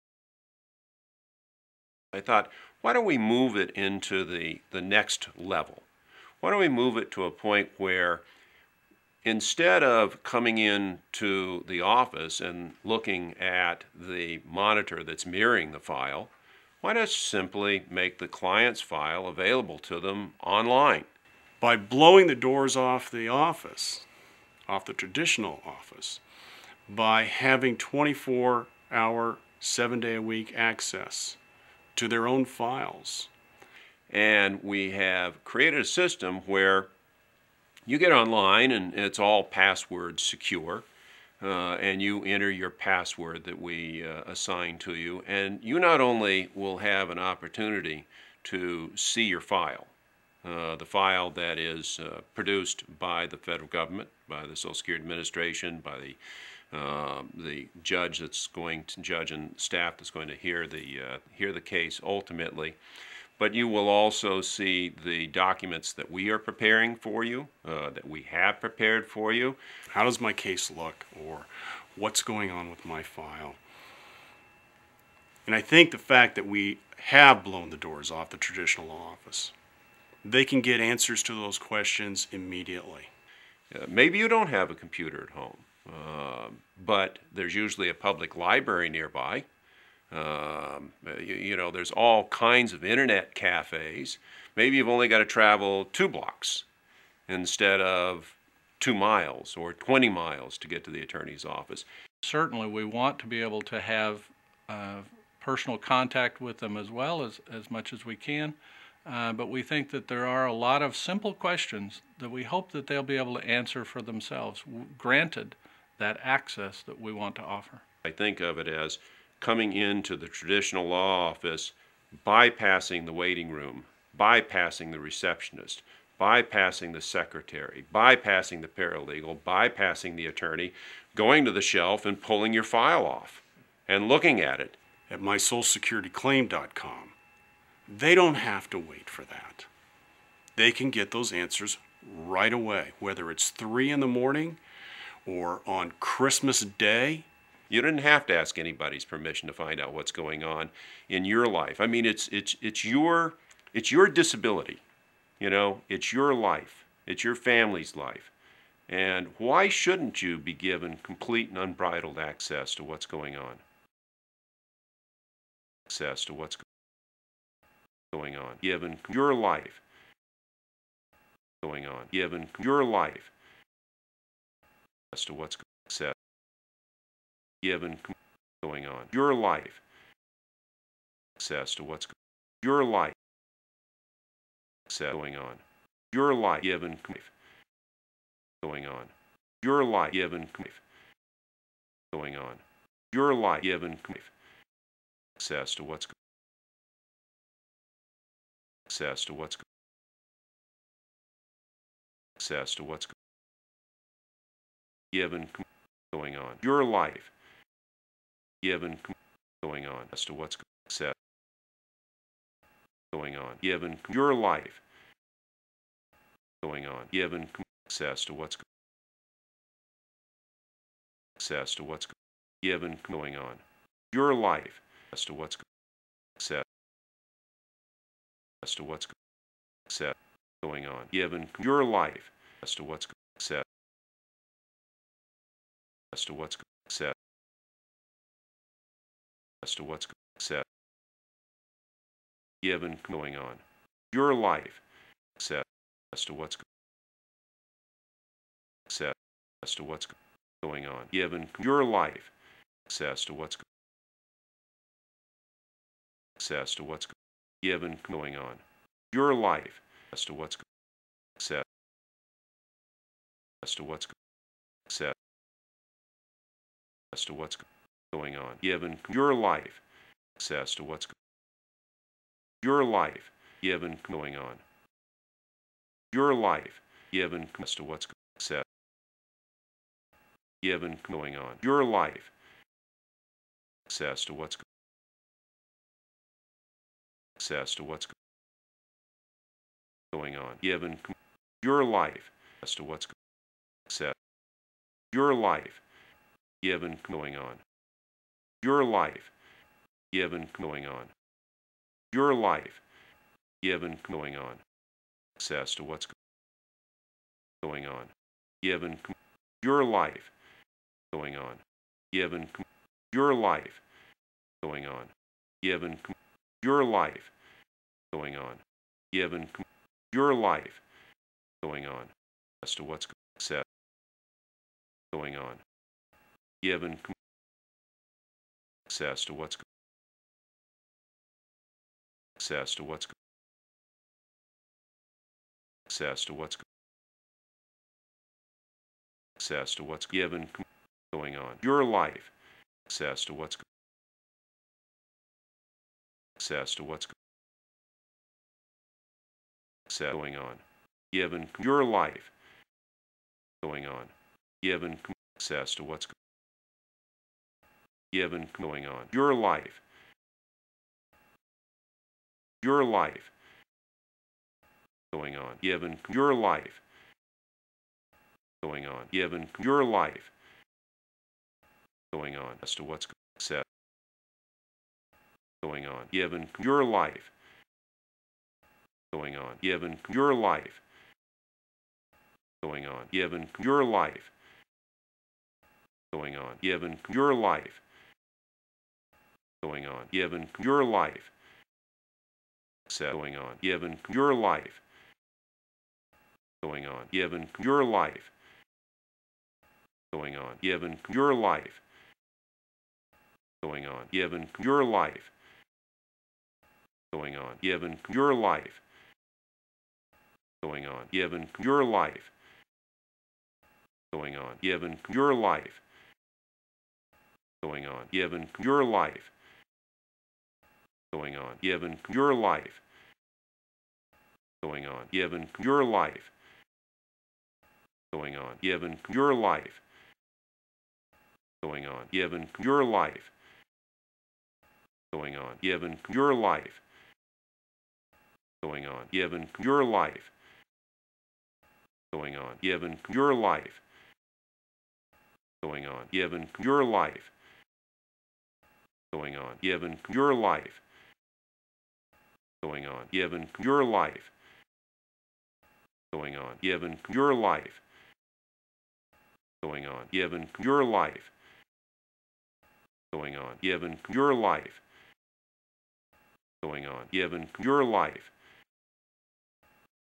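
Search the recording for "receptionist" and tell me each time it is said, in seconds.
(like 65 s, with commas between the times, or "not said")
124 s.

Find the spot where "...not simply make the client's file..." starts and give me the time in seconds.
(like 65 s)
16 s.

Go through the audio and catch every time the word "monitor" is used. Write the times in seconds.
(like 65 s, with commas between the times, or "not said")
14 s.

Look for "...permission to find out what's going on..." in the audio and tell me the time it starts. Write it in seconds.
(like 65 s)
149 s.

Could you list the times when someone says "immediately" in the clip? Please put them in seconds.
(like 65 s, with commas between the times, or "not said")
82 s.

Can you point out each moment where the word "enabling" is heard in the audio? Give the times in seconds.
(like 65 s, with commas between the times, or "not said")
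not said.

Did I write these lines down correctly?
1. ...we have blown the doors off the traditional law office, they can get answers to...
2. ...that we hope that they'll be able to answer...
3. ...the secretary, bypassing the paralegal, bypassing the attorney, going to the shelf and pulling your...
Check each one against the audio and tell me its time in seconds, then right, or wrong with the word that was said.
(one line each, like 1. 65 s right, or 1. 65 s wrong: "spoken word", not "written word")
1. 76 s right
2. 112 s right
3. 126 s right.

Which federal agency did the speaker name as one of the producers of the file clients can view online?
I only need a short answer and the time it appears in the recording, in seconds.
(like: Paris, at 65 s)
Social Security Administration, at 54 s.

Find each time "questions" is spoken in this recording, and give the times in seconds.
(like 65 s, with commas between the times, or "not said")
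81 s, 111 s.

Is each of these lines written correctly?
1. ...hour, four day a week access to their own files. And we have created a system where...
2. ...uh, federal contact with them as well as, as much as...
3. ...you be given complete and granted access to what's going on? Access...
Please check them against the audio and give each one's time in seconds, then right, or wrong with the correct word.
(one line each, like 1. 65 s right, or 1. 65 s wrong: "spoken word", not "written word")
1. 28 s wrong: "seven", not "four"
2. 104 s wrong: "personal", not "federal"
3. 160 s wrong: "unbridled", not "granted".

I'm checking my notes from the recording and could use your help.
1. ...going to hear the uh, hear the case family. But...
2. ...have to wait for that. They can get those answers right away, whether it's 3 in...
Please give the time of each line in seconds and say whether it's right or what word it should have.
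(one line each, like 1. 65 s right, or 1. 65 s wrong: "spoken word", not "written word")
1. 60 s wrong: "ultimately", not "family"
2. 138 s right.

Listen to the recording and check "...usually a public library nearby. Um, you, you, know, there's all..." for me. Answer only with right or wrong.
right.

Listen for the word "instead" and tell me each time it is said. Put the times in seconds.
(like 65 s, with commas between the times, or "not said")
9 s, 97 s.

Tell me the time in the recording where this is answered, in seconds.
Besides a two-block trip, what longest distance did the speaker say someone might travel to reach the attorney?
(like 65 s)
99 s.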